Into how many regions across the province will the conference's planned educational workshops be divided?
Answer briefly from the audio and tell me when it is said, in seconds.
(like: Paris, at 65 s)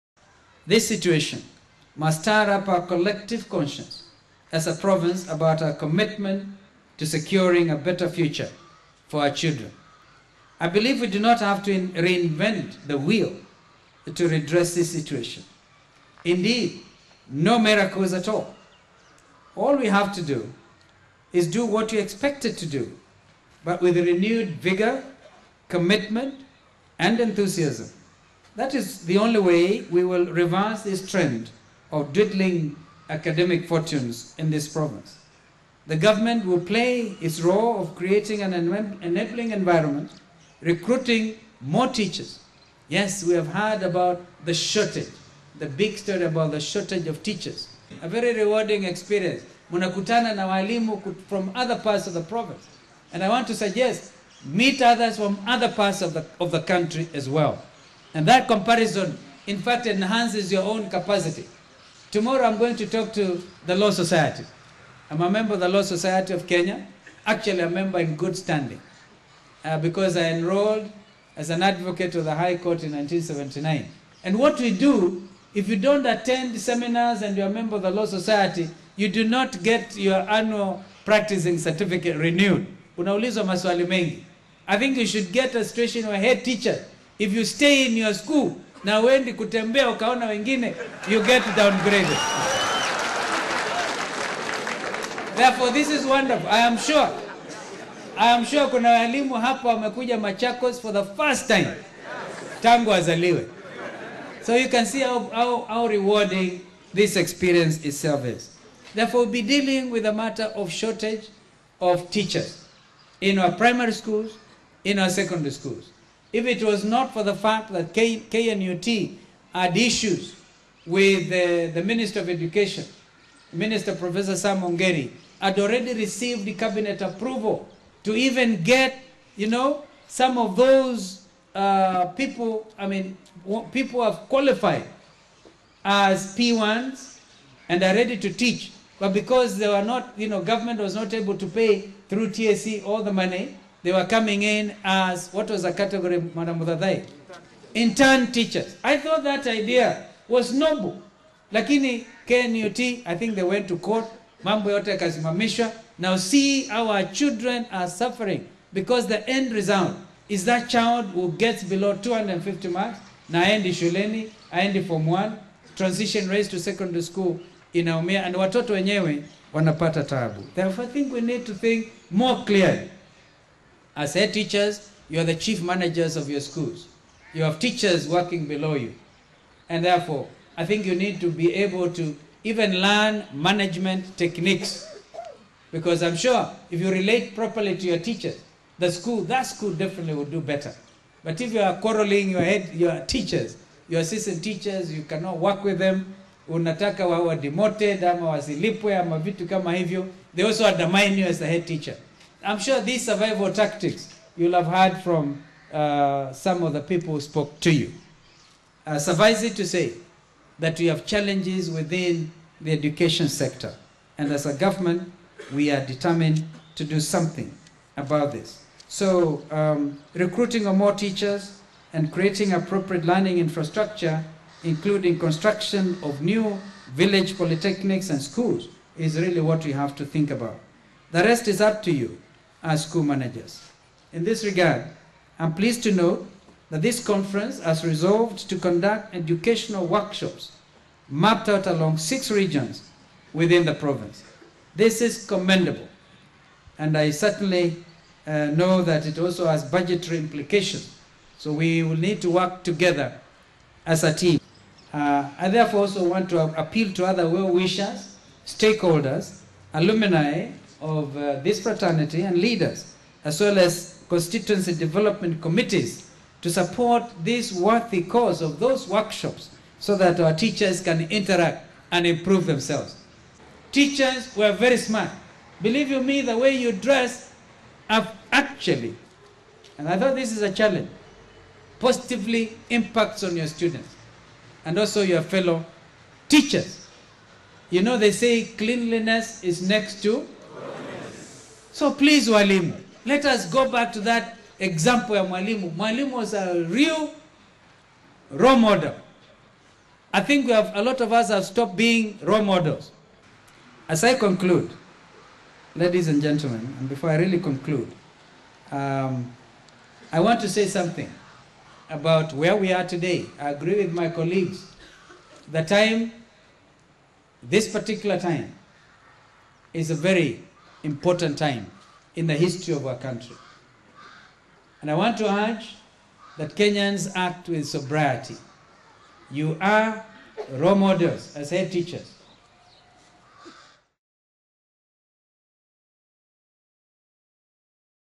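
6, at 241 s.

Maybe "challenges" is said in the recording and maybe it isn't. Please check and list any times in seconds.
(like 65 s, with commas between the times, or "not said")
211 s, 280 s.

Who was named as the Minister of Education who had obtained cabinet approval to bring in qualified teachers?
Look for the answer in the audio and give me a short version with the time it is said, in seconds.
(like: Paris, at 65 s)
Sam Ongeri, at 124 s.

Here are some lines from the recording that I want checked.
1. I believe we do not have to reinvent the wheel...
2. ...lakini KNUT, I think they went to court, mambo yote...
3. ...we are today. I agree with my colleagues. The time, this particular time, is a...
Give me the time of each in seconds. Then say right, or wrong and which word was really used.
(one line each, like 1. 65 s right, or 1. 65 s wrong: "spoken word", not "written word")
1. 10 s right
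2. 151 s right
3. 312 s right.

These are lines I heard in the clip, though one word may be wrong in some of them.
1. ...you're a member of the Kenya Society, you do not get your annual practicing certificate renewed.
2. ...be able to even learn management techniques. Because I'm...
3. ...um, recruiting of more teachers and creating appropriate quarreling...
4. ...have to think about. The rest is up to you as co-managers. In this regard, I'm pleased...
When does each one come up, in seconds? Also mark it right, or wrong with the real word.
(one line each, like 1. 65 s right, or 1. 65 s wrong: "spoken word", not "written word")
1. 77 s wrong: "Law", not "Kenya"
2. 181 s right
3. 219 s wrong: "learning", not "quarreling"
4. 229 s right.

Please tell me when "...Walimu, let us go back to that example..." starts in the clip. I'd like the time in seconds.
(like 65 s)
292 s.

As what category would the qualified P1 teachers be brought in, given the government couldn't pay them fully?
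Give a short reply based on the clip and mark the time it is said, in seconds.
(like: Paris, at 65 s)
Intern teachers, at 147 s.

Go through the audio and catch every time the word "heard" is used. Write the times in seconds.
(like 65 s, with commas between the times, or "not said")
43 s, 204 s.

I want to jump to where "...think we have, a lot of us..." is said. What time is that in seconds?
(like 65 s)
300 s.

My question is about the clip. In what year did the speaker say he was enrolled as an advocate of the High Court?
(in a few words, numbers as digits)
1979.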